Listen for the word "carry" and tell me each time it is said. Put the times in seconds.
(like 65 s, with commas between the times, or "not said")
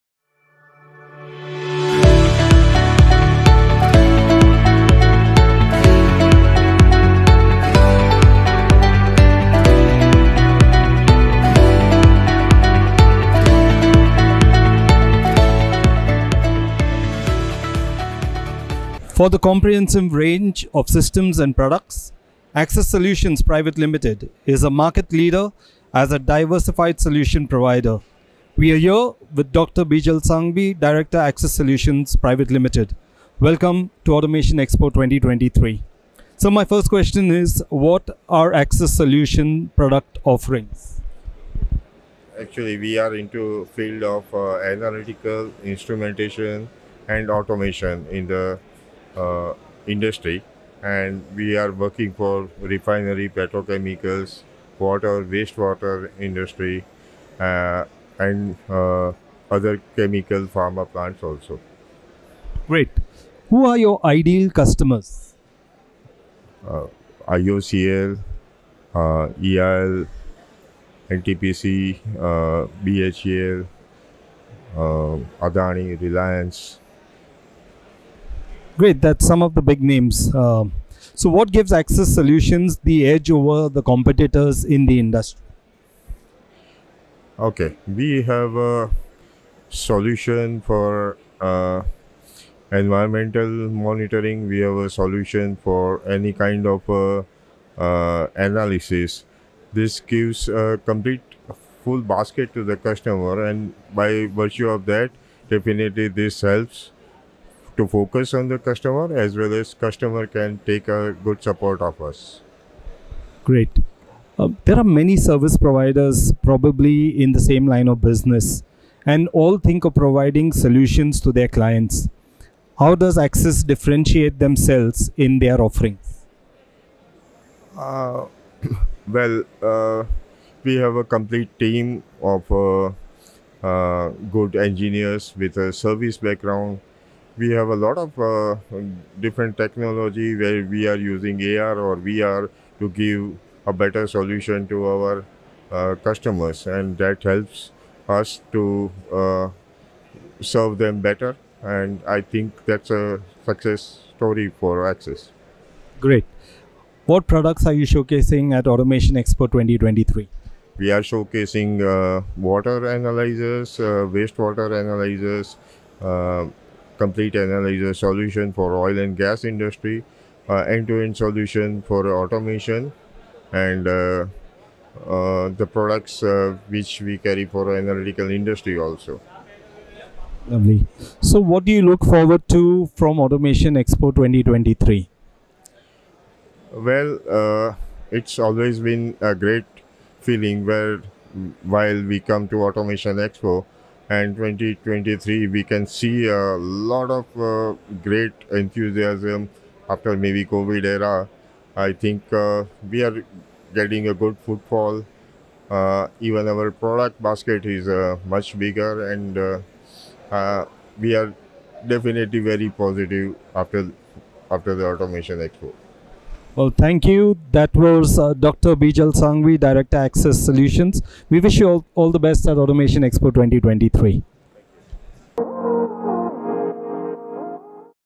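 177 s.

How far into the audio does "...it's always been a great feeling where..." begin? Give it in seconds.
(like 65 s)
188 s.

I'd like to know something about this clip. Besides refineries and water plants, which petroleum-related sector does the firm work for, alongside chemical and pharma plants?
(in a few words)
petrochemicals.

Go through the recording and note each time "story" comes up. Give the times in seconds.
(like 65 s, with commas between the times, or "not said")
154 s.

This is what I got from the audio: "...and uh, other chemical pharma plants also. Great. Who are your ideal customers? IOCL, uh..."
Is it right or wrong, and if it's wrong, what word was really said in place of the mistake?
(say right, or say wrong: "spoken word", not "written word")
right.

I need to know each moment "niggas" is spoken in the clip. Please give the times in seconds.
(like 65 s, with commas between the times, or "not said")
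not said.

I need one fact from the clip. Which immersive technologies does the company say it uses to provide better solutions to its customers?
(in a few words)
AR or VR.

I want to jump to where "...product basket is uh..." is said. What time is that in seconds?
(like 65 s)
206 s.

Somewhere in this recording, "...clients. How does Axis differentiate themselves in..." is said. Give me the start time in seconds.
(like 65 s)
121 s.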